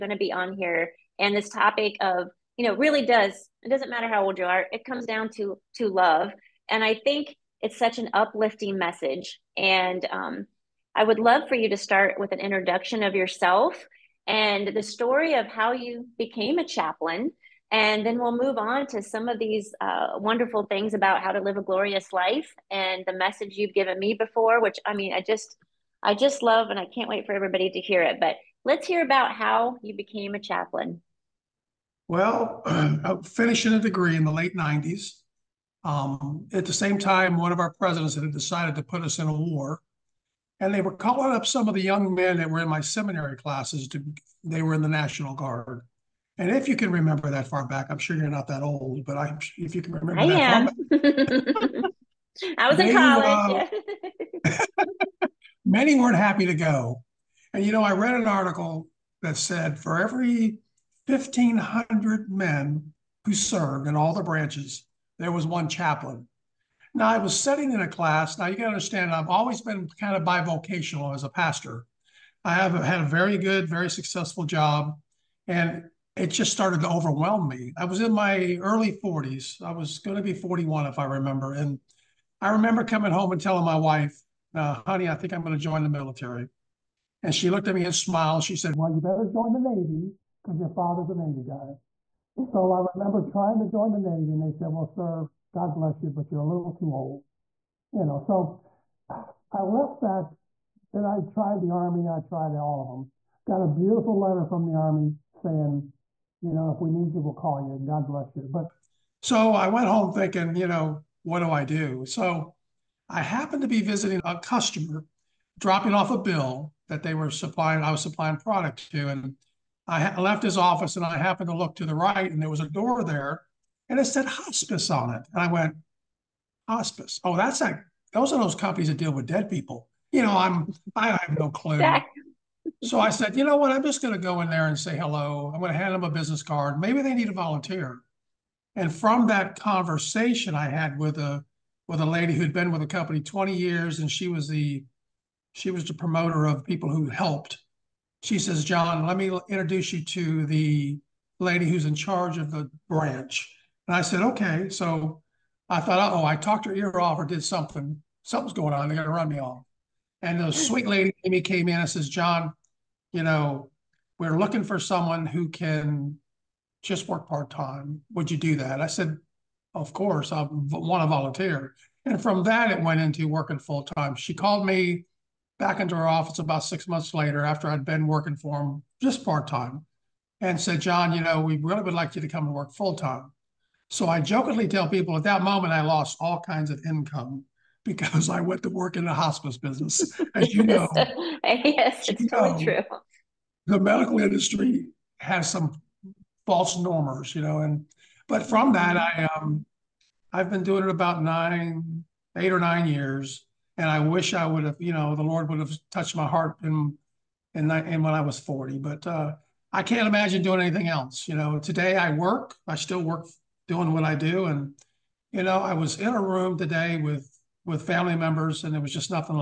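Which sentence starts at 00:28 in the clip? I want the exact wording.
But let's hear about how you became a chaplain.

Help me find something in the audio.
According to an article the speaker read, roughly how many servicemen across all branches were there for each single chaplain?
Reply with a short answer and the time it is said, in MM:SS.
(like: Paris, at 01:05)
1,500, at 01:01.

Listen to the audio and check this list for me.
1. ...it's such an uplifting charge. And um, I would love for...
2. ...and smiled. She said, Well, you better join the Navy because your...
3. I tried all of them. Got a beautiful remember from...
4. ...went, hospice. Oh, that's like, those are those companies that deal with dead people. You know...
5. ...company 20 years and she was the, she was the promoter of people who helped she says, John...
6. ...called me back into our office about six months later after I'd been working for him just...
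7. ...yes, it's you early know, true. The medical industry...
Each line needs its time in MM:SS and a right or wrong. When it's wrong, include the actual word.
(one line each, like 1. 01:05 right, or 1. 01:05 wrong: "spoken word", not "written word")
1. 00:07 wrong: "message", not "charge"
2. 01:27 right
3. 01:42 wrong: "letter", not "remember"
4. 02:05 right
5. 02:22 right
6. 02:54 right
7. 03:10 wrong: "totally", not "early".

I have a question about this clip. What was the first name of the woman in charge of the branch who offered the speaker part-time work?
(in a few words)
Amy.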